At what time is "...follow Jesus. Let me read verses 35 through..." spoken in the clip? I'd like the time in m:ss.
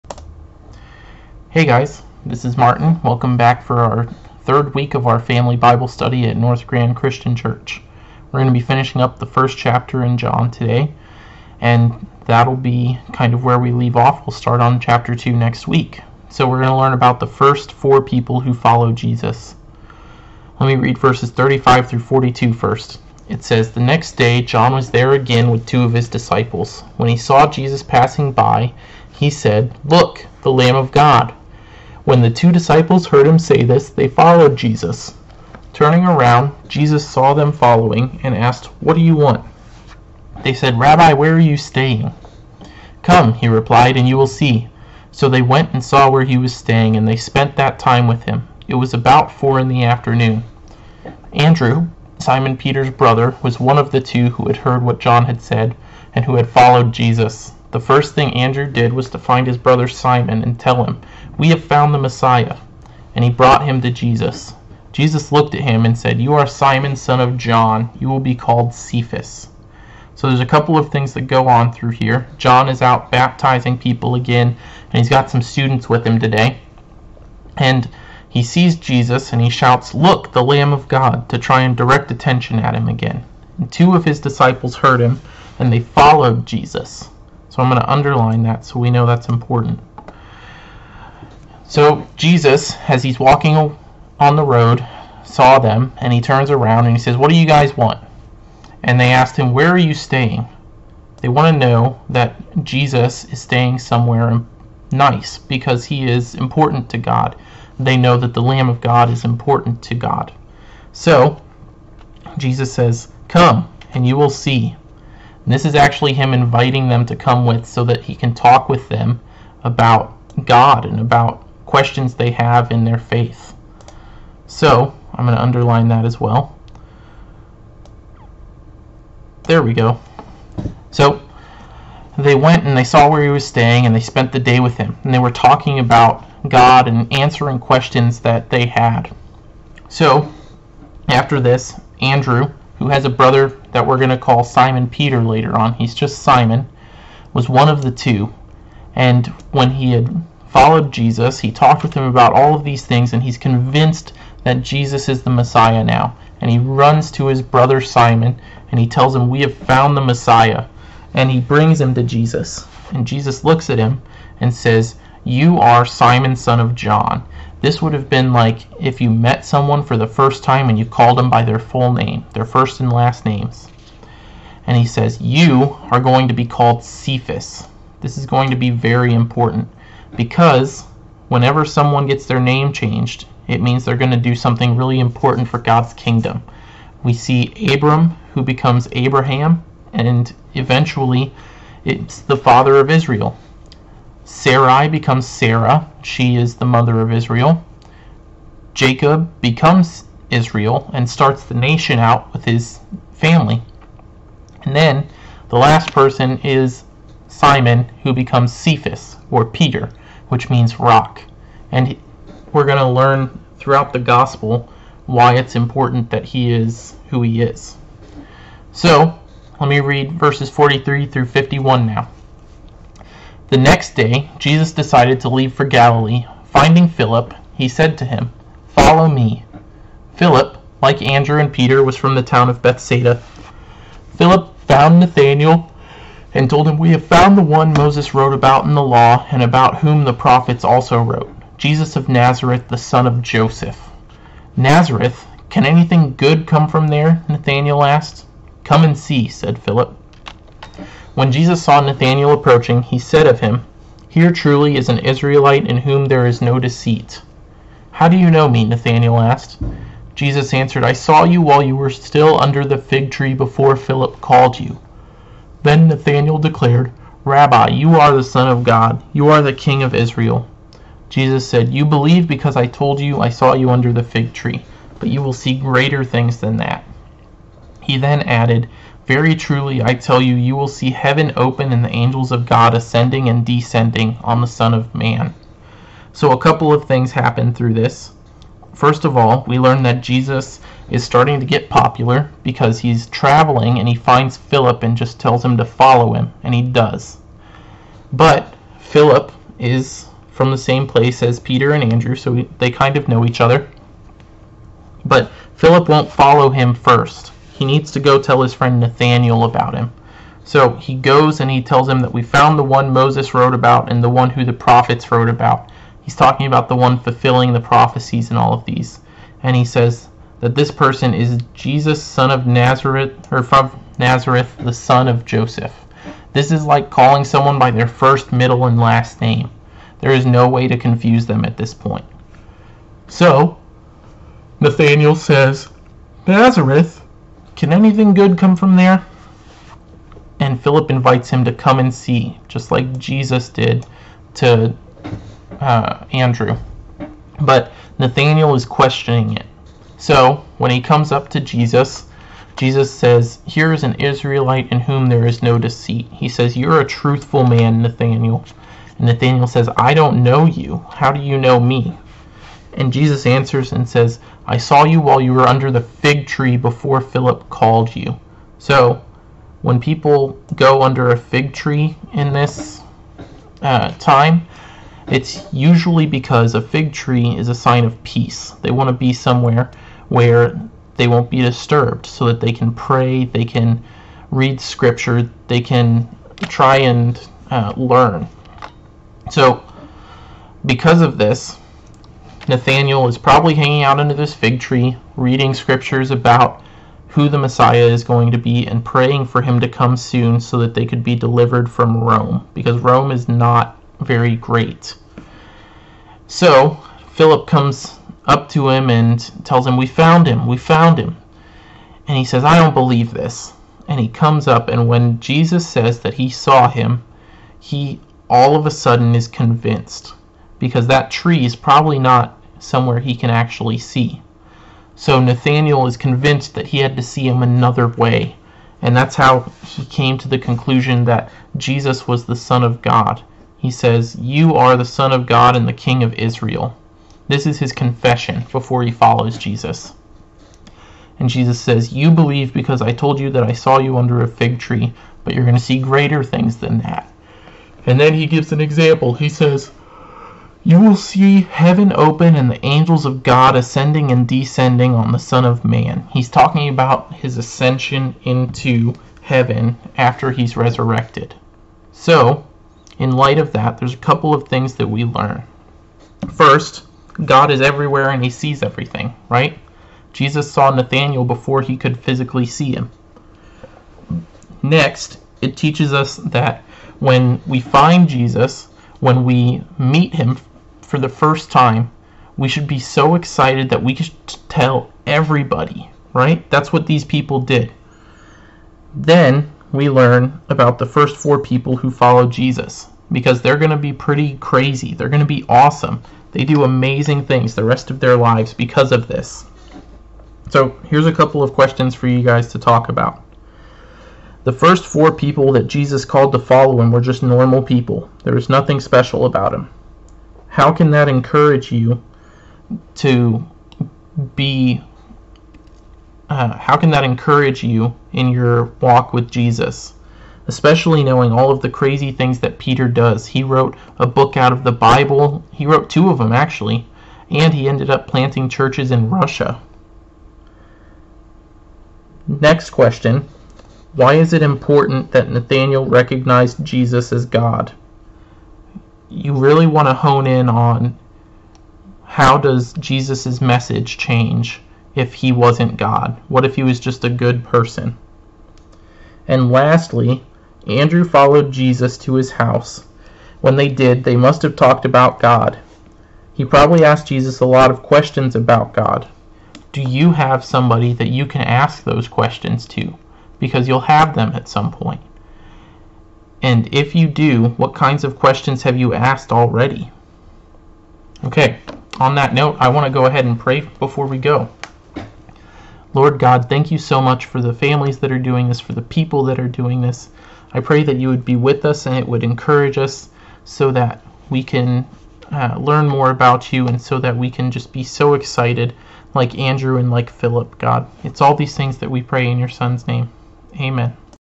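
0:18.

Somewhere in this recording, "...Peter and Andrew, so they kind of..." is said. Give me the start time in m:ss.
5:01.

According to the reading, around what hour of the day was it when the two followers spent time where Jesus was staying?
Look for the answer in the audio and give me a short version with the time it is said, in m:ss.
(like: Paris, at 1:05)
4 in the afternoon, at 0:49.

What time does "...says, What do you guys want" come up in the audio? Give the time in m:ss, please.
1:37.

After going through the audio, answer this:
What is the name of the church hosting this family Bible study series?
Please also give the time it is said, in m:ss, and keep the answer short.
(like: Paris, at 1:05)
North Grand Christian Church, at 0:06.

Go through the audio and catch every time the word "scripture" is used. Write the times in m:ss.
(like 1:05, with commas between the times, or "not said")
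6:24, 6:35.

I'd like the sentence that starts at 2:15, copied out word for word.
And they were talking about God and answering questions that they had.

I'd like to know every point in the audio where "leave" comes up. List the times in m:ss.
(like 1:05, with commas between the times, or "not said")
0:13, 3:45.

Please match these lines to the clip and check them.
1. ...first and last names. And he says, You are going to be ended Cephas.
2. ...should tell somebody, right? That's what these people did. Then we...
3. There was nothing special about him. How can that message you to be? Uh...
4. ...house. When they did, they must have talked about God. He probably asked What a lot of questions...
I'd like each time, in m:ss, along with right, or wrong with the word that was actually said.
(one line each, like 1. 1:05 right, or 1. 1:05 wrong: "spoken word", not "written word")
1. 2:52 wrong: "called", not "ended"
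2. 8:03 wrong: "everybody", not "somebody"
3. 8:28 wrong: "encourage", not "message"
4. 9:12 wrong: "Jesus", not "What".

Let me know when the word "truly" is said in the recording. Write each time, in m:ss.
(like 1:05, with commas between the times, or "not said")
4:14, 4:39.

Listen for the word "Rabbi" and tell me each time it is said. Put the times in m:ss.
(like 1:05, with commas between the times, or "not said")
0:40, 4:27.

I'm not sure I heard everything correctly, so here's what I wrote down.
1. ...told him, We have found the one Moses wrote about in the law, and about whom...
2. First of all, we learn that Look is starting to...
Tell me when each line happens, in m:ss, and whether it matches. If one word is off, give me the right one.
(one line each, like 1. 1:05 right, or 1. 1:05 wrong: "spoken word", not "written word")
1. 3:56 right
2. 4:48 wrong: "Jesus", not "Look".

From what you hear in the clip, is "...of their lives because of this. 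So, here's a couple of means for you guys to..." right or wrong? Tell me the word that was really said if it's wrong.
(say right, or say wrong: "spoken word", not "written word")
wrong: "questions", not "means".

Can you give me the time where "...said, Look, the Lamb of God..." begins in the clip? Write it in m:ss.
0:29.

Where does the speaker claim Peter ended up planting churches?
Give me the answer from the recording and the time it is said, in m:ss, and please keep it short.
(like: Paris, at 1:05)
Russia, at 8:49.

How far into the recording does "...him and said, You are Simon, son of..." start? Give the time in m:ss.
1:05.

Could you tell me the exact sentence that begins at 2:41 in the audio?
And he brings him to Jesus.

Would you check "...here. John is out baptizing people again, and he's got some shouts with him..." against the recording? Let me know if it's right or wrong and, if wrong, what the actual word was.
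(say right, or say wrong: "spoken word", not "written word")
wrong: "students", not "shouts".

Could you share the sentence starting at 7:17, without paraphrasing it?
This is his confession before he follows Jesus.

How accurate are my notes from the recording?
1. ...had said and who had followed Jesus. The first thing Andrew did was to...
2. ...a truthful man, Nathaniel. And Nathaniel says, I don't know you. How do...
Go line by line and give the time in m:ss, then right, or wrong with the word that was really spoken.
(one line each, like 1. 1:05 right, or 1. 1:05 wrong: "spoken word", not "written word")
1. 0:55 right
2. 5:56 right.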